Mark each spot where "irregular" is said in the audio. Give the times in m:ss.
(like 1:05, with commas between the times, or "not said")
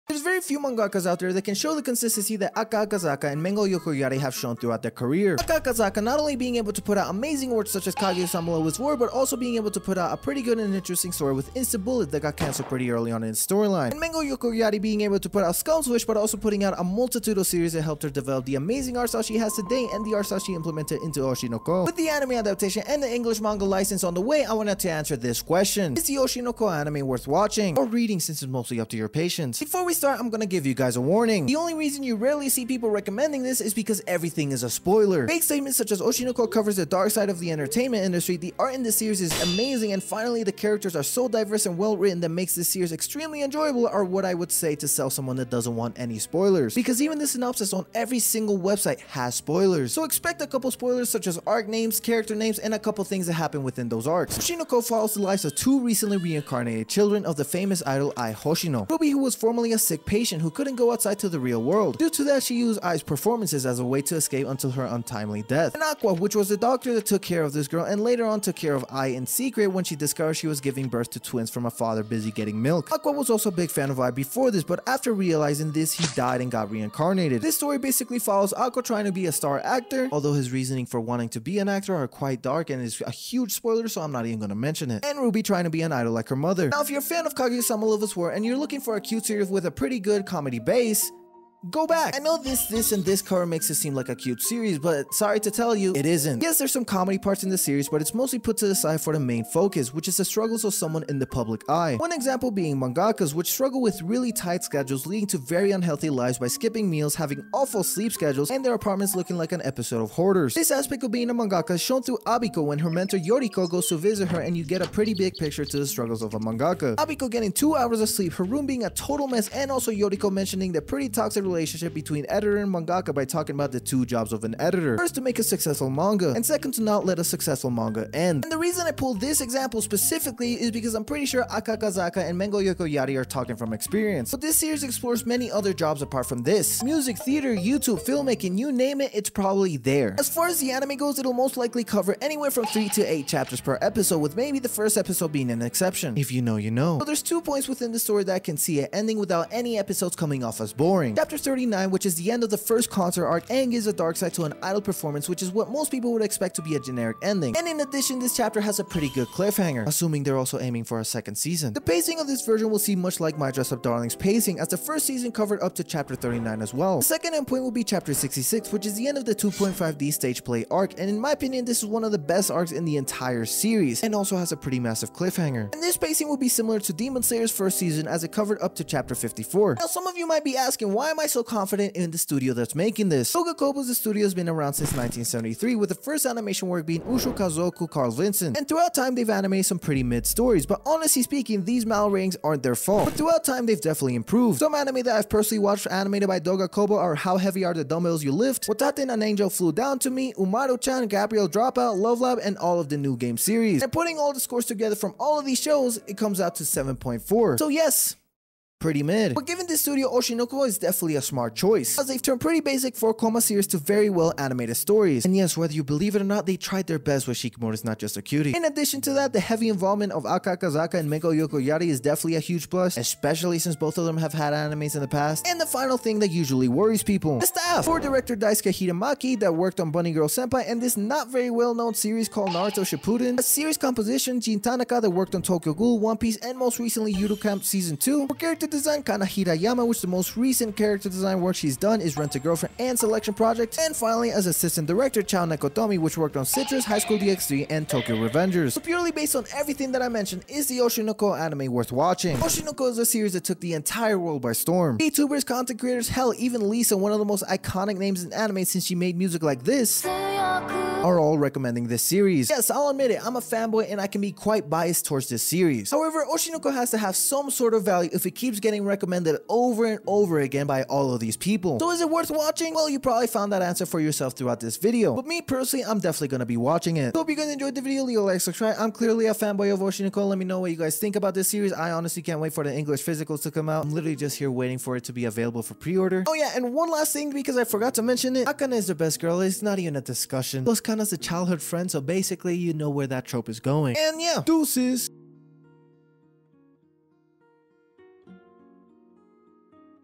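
not said.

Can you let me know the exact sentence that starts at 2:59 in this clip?
Now, some of you might be asking, why am I so confident in the studio that's making this?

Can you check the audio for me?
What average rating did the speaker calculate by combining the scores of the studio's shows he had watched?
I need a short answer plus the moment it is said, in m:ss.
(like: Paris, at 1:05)
7.4, at 3:26.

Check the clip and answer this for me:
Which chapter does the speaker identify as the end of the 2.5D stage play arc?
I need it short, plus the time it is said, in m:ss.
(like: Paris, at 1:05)
66, at 2:48.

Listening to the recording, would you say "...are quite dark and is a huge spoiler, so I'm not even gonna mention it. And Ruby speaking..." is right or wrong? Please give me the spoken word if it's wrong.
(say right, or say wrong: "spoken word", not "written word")
wrong: "trying", not "speaking".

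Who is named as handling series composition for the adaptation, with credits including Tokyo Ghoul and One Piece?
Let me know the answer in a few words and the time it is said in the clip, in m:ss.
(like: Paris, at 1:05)
Jin Tanaka, at 3:54.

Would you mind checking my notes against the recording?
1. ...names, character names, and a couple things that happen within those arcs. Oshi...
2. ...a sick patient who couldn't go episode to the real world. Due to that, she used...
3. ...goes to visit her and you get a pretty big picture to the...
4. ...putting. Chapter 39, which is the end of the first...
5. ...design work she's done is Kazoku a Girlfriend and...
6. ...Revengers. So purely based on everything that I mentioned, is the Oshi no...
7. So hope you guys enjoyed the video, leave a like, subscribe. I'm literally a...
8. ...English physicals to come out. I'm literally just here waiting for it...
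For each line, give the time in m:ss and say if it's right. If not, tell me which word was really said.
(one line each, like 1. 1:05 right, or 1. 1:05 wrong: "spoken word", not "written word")
1. 0:51 right
2. 0:59 wrong: "outside", not "episode"
3. 1:53 right
4. 2:30 wrong: "boring", not "putting"
5. 4:01 wrong: "Rent", not "Kazoku"
6. 4:08 right
7. 4:37 wrong: "clearly", not "literally"
8. 4:42 right.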